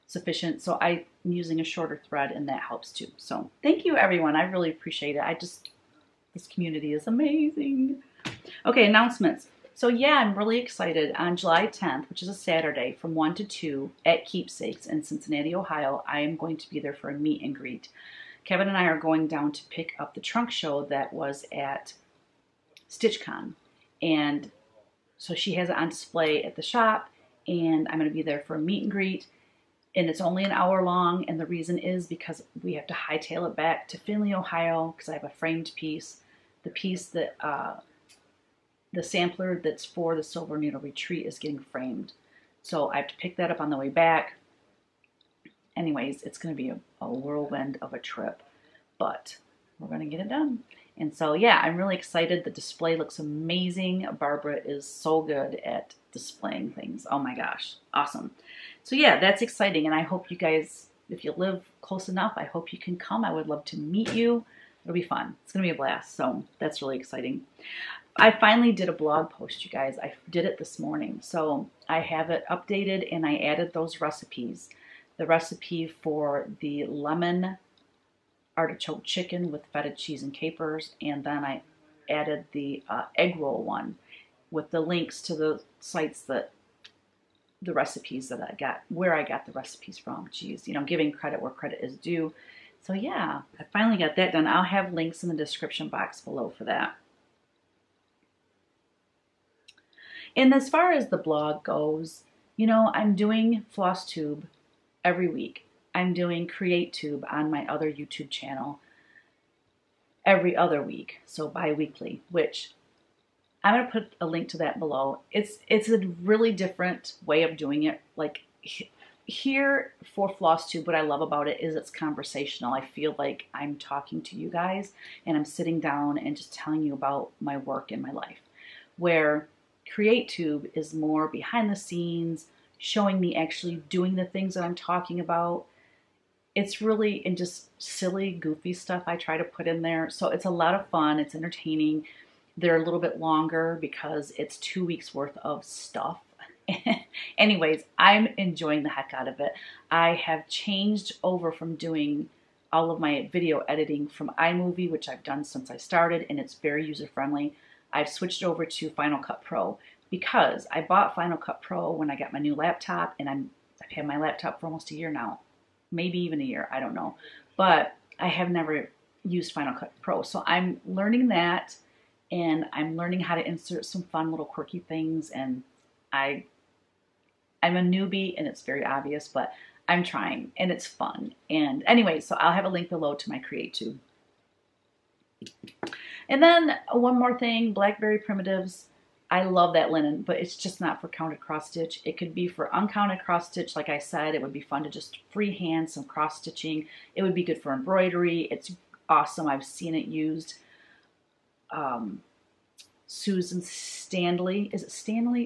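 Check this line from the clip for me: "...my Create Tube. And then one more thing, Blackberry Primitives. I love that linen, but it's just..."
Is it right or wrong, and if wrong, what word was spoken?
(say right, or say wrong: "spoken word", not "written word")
right.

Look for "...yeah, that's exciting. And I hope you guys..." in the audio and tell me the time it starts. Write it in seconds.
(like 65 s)
58 s.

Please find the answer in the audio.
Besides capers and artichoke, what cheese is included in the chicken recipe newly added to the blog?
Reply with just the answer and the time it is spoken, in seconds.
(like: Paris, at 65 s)
Feta, at 79 s.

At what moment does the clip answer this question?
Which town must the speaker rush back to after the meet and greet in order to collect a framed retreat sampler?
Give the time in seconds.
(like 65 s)
33 s.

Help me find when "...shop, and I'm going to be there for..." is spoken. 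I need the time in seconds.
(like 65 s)
26 s.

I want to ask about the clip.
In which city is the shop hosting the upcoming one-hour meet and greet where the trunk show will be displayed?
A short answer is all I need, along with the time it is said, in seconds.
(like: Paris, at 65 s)
Cincinnati, at 15 s.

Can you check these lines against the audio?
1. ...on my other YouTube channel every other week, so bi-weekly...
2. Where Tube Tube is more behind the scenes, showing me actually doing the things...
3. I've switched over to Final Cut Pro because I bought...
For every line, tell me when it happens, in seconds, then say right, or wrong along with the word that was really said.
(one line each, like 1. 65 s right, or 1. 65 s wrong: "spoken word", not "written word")
1. 107 s right
2. 128 s wrong: "Create", not "Tube"
3. 157 s right.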